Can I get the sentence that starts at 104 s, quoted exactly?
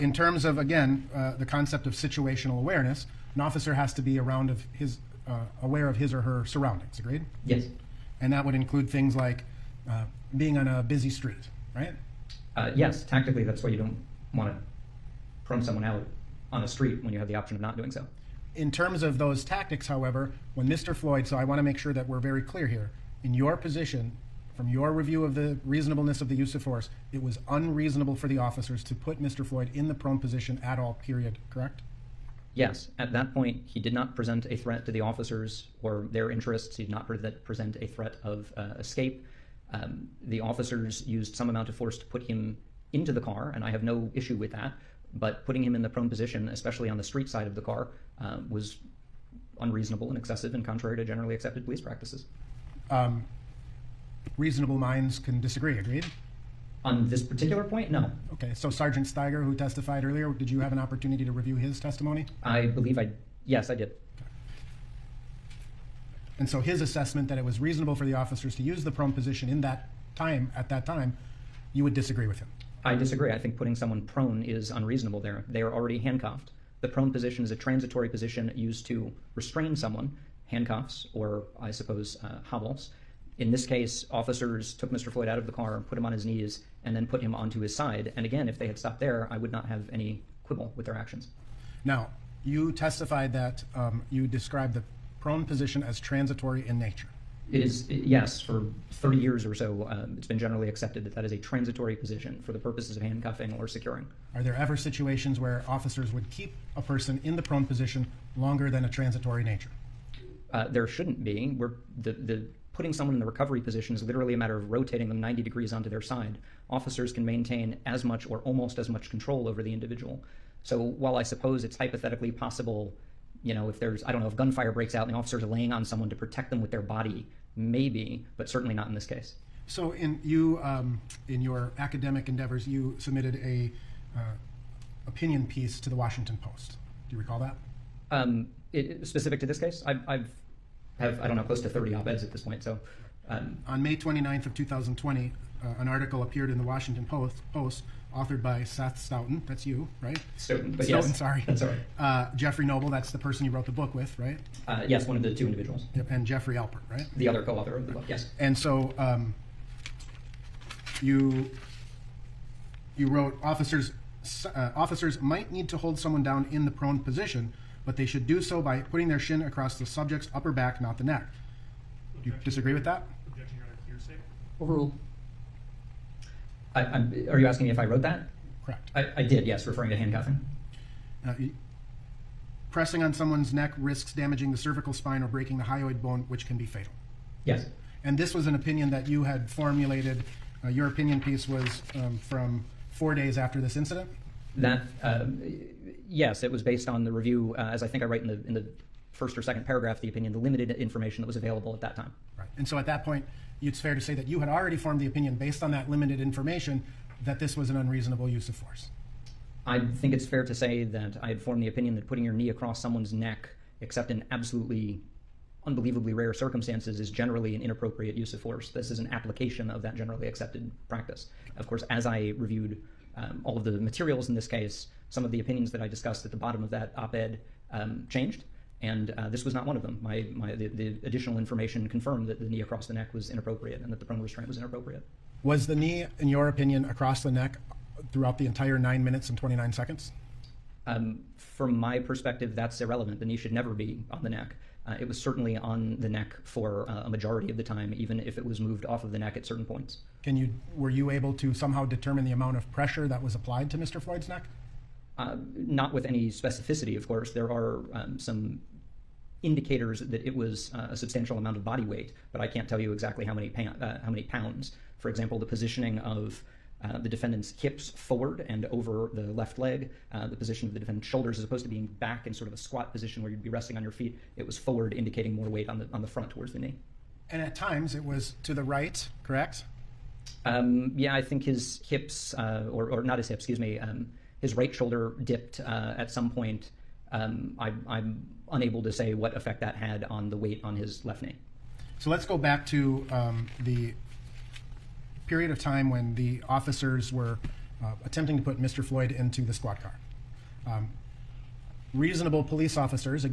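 Are there ever situations where officers would keep a person in the prone position longer than a transitory nature?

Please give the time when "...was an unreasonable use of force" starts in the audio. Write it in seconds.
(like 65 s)
207 s.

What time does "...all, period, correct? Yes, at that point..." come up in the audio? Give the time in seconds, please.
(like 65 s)
30 s.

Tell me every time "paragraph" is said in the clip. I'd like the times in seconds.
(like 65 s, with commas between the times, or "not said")
199 s.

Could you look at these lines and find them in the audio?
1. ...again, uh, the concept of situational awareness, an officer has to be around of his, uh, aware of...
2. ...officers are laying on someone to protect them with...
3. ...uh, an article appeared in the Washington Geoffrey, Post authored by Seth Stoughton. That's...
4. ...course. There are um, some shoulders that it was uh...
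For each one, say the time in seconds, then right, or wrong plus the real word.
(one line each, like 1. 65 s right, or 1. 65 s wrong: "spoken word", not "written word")
1. 0 s right
2. 125 s right
3. 145 s wrong: "Post", not "Geoffrey"
4. 257 s wrong: "indicators", not "shoulders".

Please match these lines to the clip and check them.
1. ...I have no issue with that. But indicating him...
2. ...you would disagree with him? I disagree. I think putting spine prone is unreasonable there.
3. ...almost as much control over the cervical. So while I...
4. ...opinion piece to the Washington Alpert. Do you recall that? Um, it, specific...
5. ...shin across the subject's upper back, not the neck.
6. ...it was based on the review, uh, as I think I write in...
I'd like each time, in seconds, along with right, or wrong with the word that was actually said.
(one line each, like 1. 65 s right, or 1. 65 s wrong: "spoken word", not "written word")
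1. 43 s wrong: "putting", not "indicating"
2. 71 s wrong: "someone", not "spine"
3. 118 s wrong: "individual", not "cervical"
4. 135 s wrong: "Post", not "Alpert"
5. 169 s right
6. 196 s right.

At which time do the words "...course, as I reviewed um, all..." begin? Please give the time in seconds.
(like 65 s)
221 s.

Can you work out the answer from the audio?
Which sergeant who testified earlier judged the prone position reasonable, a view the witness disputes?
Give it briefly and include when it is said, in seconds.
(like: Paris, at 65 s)
Stiger, at 58 s.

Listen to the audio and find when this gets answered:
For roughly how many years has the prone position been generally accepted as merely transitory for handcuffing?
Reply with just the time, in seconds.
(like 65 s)
98 s.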